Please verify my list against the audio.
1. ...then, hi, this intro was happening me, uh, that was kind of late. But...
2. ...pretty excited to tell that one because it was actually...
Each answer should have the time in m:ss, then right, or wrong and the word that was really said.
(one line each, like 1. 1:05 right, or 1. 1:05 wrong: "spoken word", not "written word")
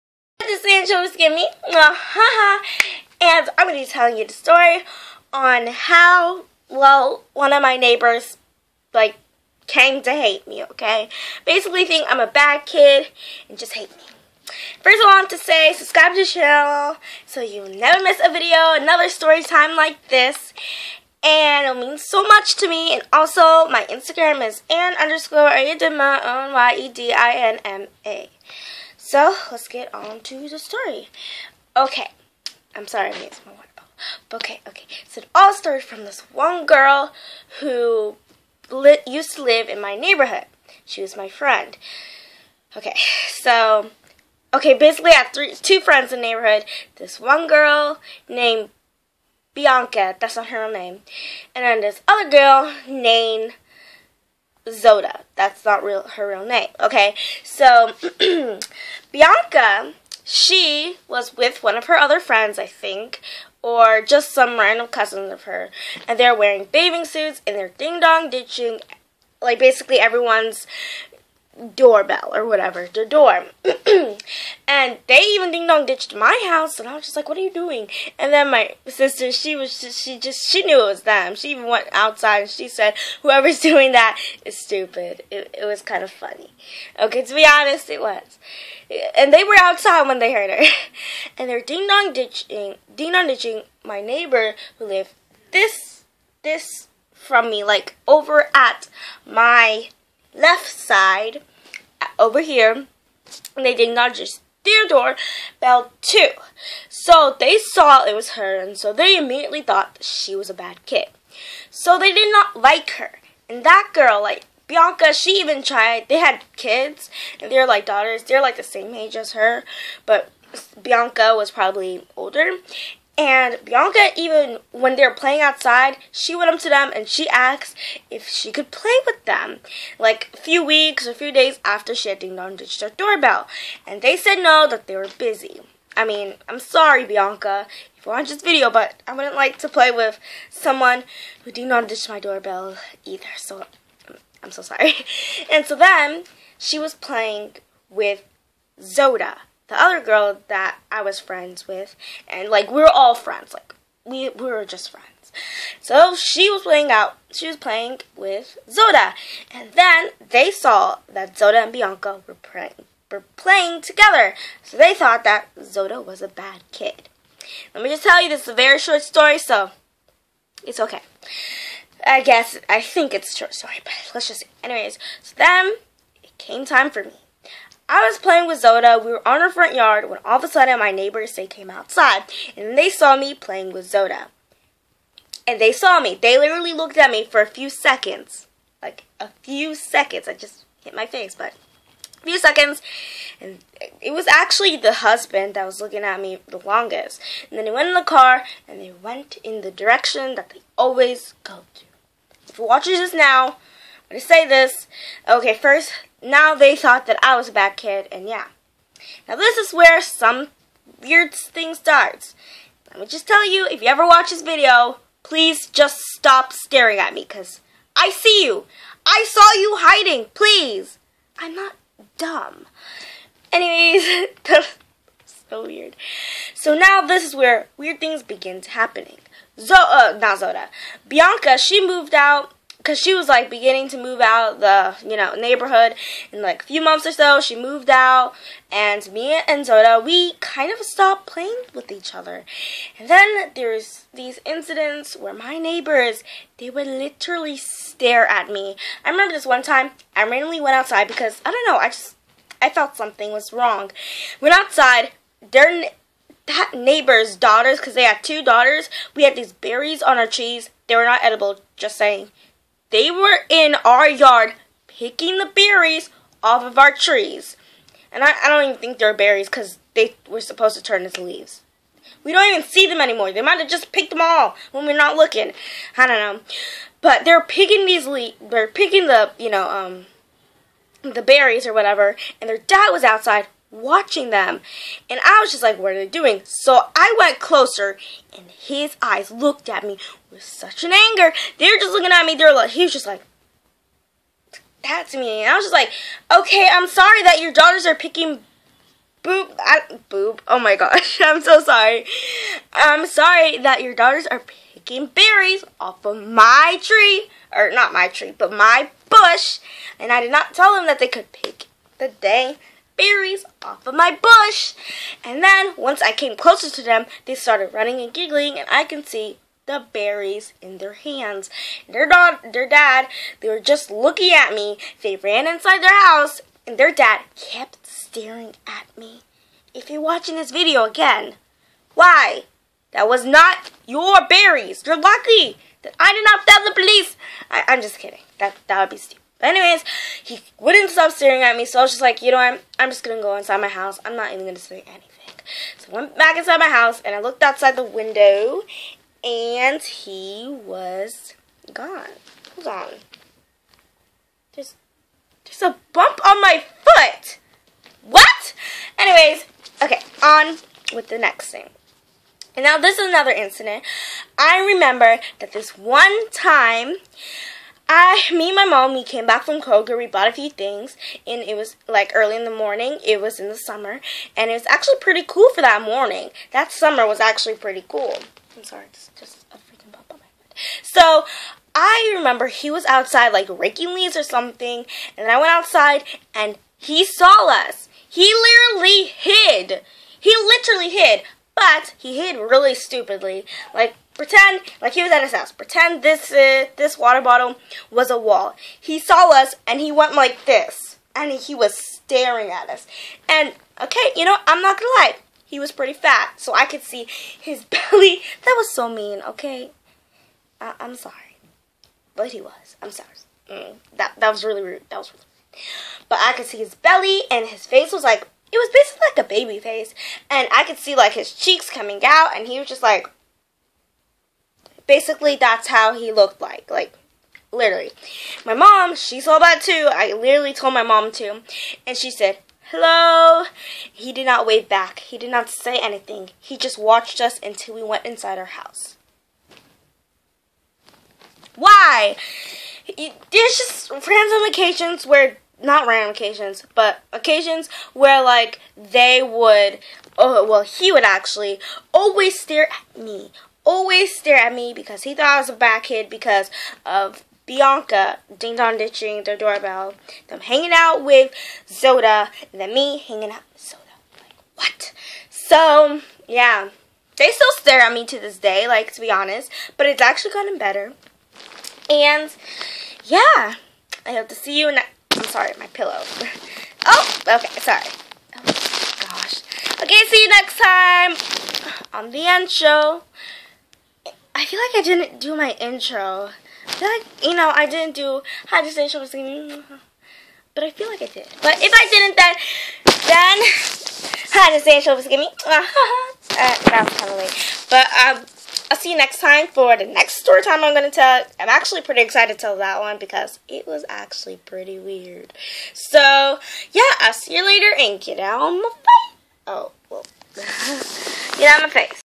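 1. 8:13 wrong: "giving", not "happening"
2. 8:21 right.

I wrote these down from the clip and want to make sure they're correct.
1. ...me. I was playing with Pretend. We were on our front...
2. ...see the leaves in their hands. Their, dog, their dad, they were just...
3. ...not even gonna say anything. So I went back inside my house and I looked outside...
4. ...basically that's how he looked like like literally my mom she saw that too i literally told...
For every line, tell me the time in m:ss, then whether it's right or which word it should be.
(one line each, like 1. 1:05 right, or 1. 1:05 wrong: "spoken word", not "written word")
1. 2:57 wrong: "Zoda", not "Pretend"
2. 5:19 wrong: "berries", not "leaves"
3. 5:44 right
4. 7:04 right.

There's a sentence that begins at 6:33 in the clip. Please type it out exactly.
Like Pretend like he was at his house.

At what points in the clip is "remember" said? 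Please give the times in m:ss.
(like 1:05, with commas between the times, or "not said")
4:09, 6:04, 6:22.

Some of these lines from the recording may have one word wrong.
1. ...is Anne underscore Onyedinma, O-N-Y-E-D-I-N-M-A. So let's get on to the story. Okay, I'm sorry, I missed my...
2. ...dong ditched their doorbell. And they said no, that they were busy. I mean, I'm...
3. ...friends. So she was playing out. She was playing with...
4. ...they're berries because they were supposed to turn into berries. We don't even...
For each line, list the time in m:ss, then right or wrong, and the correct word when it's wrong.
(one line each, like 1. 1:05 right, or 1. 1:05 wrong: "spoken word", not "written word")
1. 0:24 right
2. 2:12 right
3. 2:34 right
4. 4:28 wrong: "leaves", not "berries".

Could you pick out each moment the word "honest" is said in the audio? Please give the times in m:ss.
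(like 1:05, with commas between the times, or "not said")
1:27, 7:49.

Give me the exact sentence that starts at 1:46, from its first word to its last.
So they saw it was her, and so they immediately thought she was a bad kid.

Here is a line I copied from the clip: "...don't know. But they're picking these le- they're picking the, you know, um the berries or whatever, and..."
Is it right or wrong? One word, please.
right.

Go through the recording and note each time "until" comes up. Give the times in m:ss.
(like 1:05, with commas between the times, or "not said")
7:17.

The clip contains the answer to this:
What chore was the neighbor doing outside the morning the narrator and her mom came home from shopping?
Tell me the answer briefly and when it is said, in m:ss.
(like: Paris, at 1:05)
raking leaves, at 6:23.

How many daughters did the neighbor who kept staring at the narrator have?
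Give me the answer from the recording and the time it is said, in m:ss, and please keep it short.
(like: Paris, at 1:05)
2, at 4:18.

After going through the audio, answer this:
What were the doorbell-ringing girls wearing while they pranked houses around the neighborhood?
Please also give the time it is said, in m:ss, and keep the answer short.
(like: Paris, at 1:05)
bathing suits, at 1:06.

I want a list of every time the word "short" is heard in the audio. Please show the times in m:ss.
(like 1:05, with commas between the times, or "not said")
2:48, 2:53.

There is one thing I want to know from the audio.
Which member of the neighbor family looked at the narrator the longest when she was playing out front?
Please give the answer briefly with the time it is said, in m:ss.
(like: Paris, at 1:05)
the husband, at 3:14.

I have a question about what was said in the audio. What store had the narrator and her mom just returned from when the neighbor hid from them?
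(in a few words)
Kroger.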